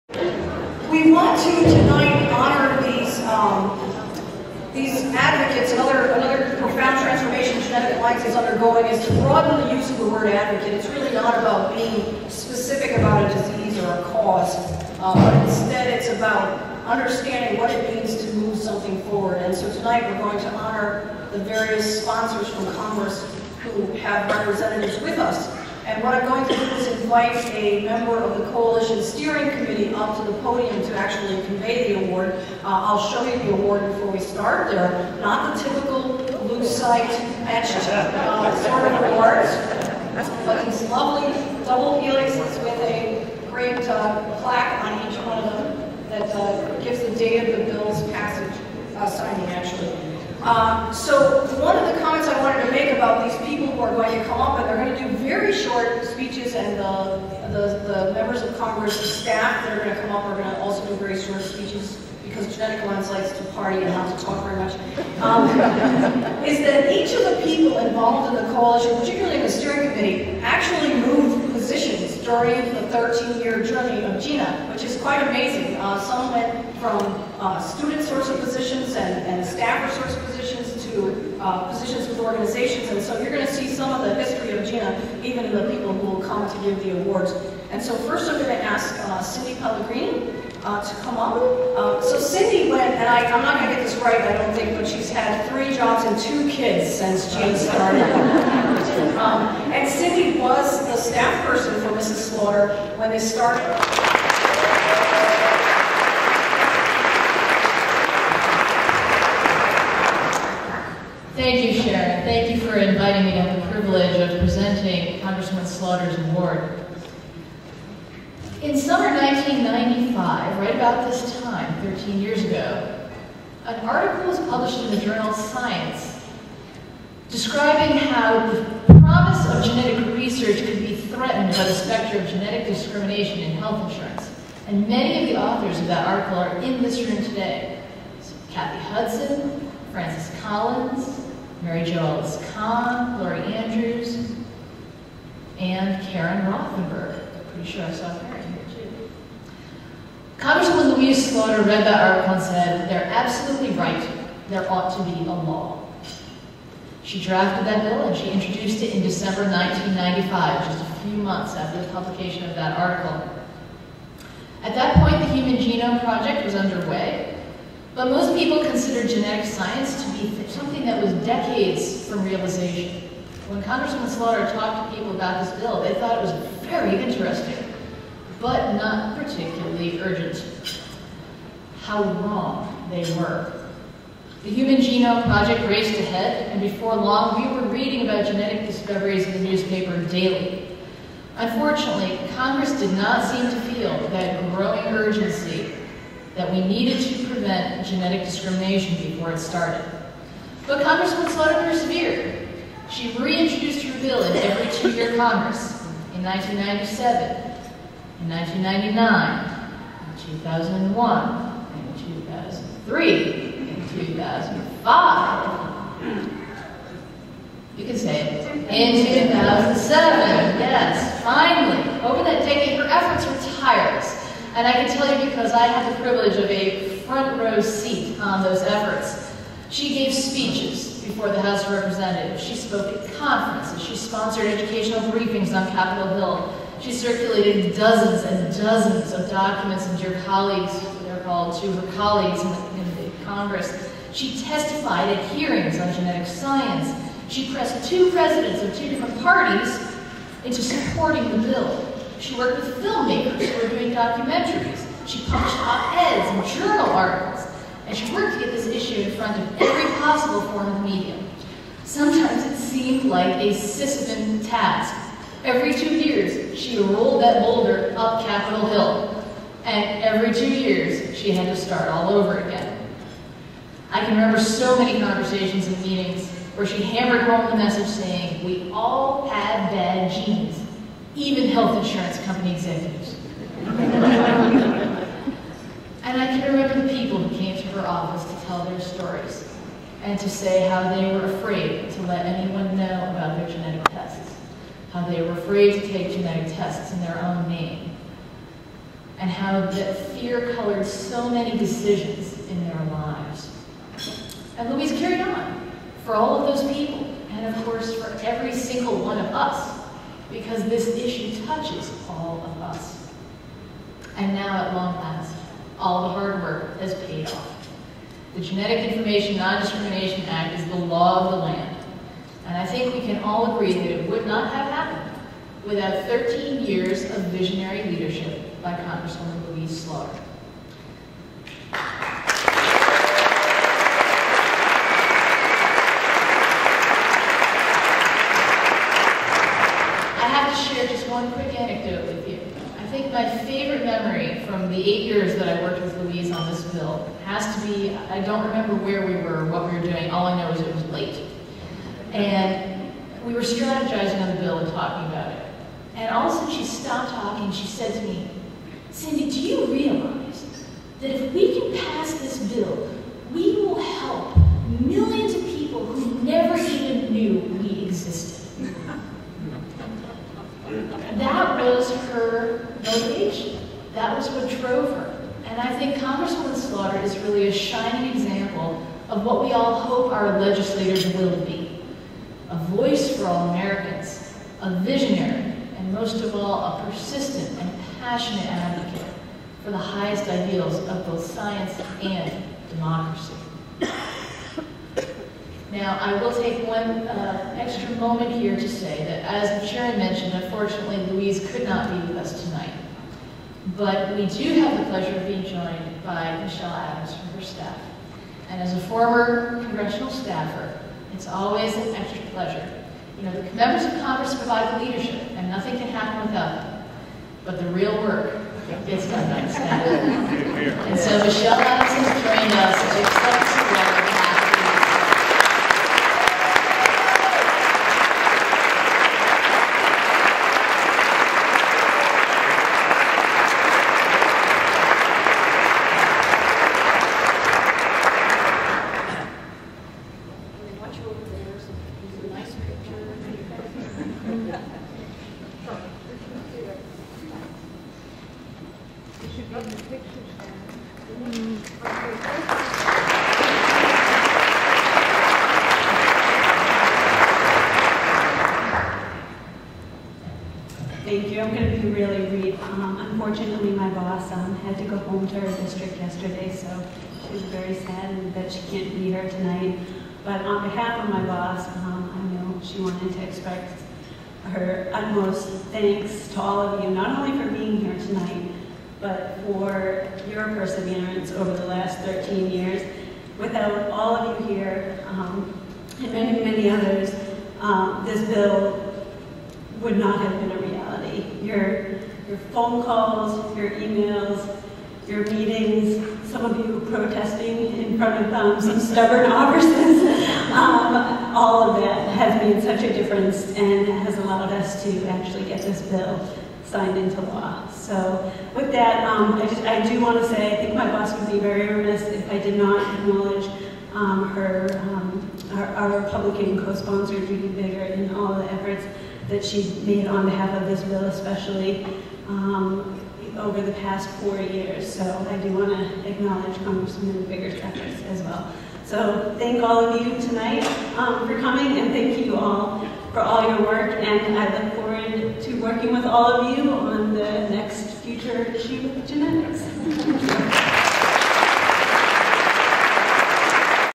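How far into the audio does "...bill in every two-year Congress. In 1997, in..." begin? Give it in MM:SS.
03:24.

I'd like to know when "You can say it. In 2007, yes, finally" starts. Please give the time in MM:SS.
03:37.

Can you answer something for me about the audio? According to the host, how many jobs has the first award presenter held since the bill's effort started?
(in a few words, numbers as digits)
3.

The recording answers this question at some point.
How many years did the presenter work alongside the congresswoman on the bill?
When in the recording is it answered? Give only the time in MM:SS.
05:44.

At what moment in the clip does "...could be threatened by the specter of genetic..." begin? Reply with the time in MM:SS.
02:10.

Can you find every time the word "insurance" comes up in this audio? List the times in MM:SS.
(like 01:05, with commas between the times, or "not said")
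02:13, 04:41.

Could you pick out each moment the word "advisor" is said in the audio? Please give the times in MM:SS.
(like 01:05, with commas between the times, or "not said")
not said.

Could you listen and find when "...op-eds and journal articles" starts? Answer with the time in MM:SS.
04:15.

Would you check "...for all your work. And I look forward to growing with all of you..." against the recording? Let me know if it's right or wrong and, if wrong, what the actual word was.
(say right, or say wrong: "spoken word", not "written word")
wrong: "working", not "growing".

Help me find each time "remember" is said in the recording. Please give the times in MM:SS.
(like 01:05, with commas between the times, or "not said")
04:34, 04:46, 05:48.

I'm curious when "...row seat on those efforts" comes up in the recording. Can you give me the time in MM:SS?
03:47.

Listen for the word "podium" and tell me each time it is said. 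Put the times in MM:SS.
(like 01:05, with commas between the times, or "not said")
00:30.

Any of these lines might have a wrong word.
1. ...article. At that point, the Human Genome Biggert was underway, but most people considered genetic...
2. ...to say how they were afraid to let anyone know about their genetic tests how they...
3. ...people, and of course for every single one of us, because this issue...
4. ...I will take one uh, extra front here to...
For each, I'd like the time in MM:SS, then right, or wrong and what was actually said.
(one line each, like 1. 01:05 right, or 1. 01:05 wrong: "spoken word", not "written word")
1. 02:42 wrong: "Project", not "Biggert"
2. 04:50 right
3. 05:06 right
4. 06:36 wrong: "moment", not "front".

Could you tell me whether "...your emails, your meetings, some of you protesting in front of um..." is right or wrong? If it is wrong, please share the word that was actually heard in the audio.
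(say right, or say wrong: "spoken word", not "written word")
right.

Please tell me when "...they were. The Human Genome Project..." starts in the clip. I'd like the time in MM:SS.
03:02.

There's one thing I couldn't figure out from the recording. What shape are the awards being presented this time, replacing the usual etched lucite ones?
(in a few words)
Double helixes.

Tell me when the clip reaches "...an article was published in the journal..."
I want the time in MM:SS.
02:03.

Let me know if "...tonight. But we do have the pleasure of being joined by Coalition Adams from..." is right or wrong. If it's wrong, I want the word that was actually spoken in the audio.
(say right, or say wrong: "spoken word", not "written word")
wrong: "Michelle", not "Coalition".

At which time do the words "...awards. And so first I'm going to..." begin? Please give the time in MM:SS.
01:27.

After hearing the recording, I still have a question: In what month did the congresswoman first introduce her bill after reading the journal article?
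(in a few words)
December.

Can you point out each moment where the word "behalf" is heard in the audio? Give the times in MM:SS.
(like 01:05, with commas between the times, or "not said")
07:50, 08:40.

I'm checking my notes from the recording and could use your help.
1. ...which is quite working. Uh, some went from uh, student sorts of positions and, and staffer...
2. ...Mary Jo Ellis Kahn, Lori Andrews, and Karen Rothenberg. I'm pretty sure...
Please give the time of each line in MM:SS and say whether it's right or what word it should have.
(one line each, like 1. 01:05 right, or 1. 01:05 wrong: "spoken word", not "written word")
1. 01:14 wrong: "amazing", not "working"
2. 02:21 right.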